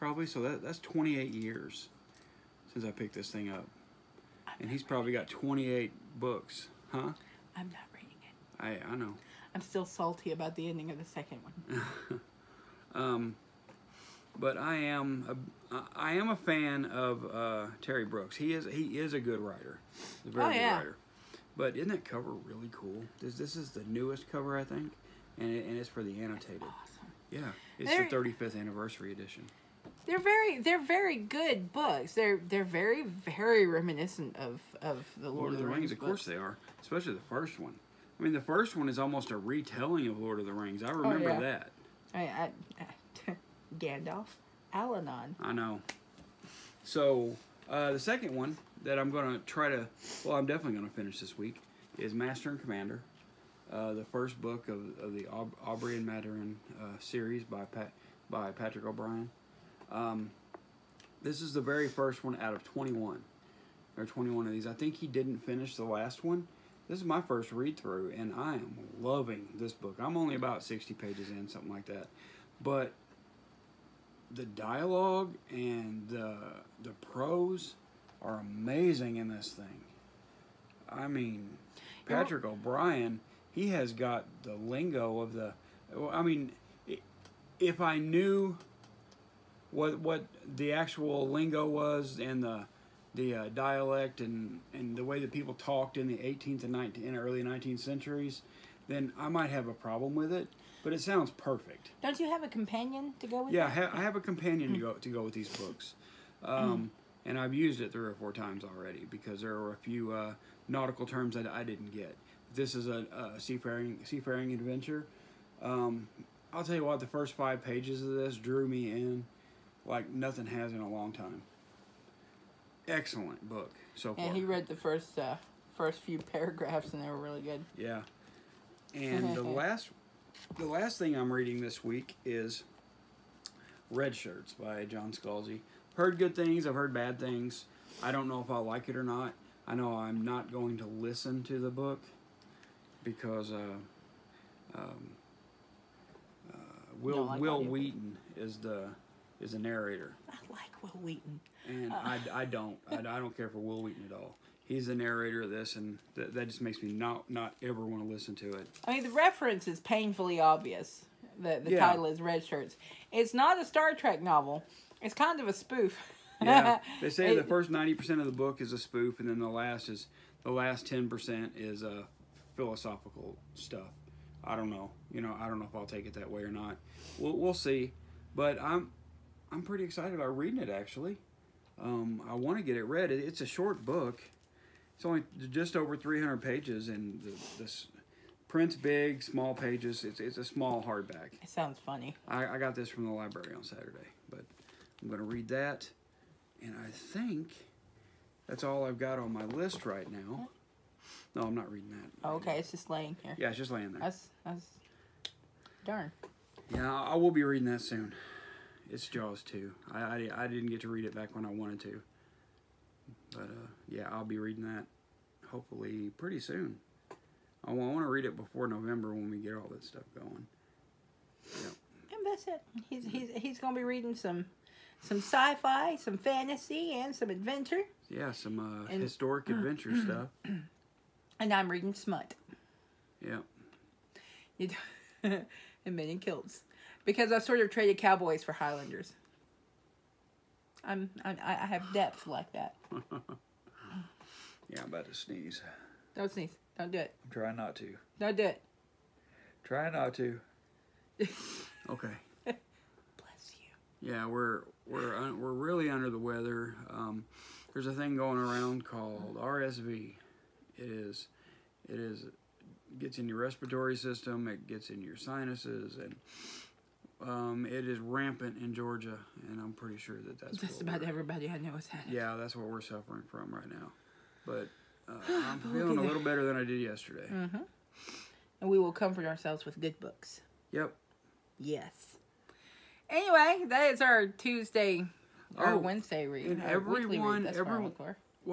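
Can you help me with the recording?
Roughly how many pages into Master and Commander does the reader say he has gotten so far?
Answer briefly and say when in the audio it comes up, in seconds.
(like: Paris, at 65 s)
60, at 70 s.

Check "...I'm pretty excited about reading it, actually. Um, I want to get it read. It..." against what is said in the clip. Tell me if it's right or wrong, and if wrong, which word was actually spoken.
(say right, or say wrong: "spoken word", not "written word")
right.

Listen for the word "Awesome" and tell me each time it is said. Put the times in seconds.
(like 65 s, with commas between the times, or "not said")
26 s.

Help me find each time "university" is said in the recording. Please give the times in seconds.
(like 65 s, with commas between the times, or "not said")
not said.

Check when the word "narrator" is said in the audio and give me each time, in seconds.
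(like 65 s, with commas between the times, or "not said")
149 s, 154 s.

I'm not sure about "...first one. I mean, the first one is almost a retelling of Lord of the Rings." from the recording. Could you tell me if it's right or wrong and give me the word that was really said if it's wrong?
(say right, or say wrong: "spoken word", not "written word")
right.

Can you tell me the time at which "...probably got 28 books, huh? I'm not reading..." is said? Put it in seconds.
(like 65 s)
4 s.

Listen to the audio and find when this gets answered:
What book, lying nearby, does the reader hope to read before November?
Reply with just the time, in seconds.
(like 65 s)
209 s.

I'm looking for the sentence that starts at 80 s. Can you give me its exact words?
I mean, Patrick O'Brian, he has got the lingo of the.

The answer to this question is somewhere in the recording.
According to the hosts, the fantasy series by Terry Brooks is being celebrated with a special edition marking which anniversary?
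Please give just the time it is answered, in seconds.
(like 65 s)
28 s.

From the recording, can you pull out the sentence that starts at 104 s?
go to go with these books.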